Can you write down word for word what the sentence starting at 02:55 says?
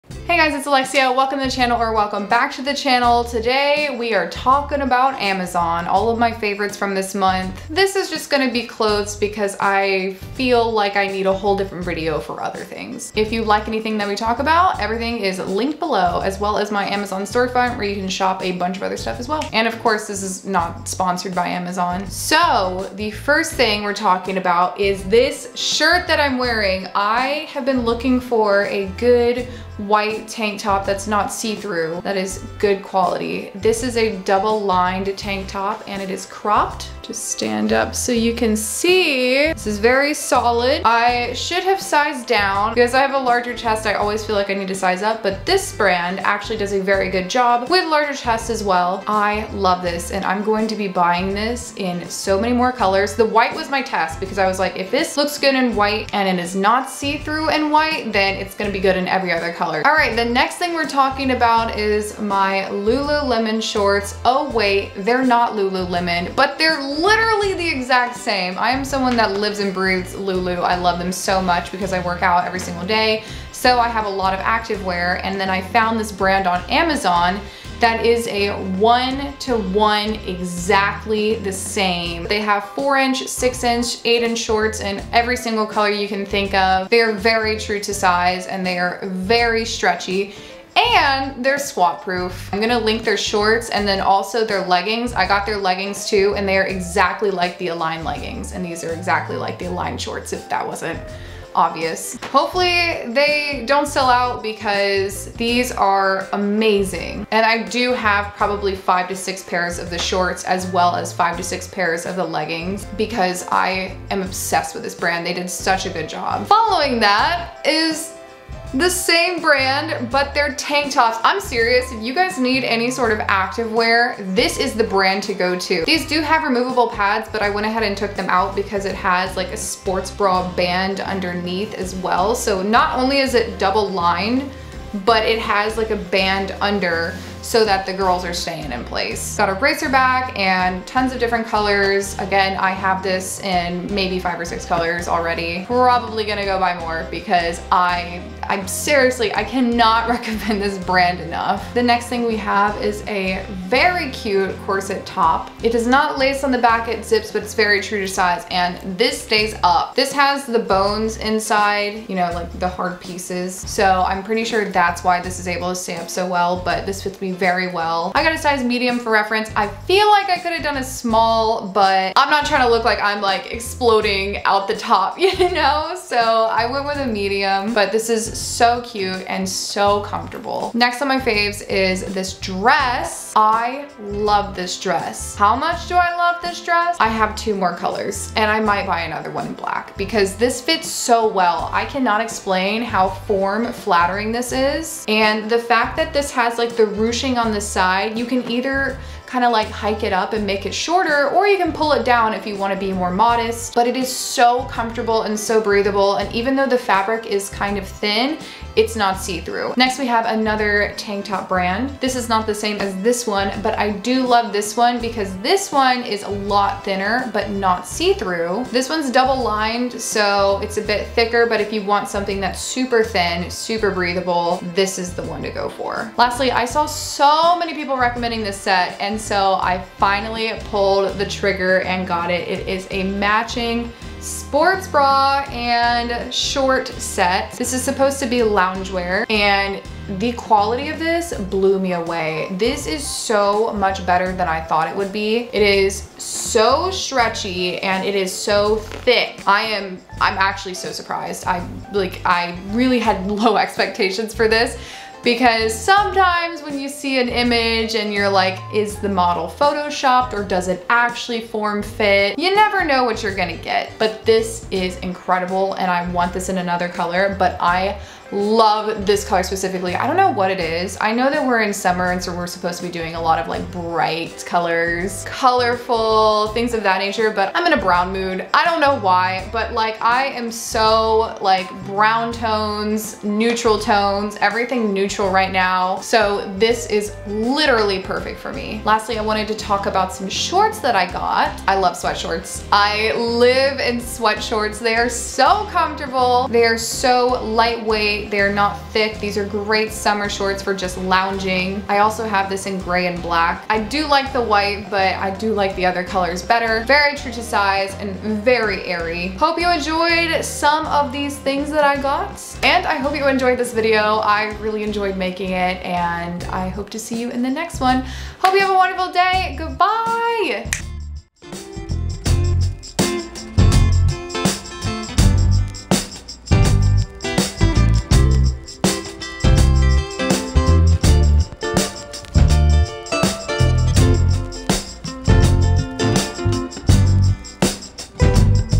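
So I went with a medium, but this is so cute and so comfortable.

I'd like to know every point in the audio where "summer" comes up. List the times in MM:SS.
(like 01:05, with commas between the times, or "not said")
04:31, 04:59.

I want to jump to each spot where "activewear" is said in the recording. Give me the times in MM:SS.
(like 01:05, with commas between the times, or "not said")
01:14, 02:03.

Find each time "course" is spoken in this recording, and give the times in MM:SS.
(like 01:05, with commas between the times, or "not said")
00:19.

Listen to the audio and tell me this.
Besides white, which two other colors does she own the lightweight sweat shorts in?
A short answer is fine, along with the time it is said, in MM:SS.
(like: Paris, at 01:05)
Gray and black, at 05:02.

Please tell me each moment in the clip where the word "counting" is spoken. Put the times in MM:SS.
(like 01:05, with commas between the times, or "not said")
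not said.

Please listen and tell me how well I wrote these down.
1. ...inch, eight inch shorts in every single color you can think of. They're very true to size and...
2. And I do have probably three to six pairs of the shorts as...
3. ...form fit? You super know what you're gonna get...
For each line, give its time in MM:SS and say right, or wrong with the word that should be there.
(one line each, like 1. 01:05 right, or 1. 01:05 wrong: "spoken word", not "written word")
1. 01:23 right
2. 01:47 wrong: "five", not "three"
3. 04:21 wrong: "never", not "super".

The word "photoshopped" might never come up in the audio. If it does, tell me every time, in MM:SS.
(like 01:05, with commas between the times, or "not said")
04:19.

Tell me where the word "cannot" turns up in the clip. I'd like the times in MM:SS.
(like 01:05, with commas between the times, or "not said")
02:29, 03:11.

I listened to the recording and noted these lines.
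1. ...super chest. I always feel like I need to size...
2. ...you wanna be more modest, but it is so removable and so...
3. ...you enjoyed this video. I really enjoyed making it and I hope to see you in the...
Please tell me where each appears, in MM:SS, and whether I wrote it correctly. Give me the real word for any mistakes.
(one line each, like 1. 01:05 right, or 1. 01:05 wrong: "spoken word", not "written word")
1. 00:43 wrong: "larger", not "super"
2. 03:22 wrong: "comfortable", not "removable"
3. 05:13 right.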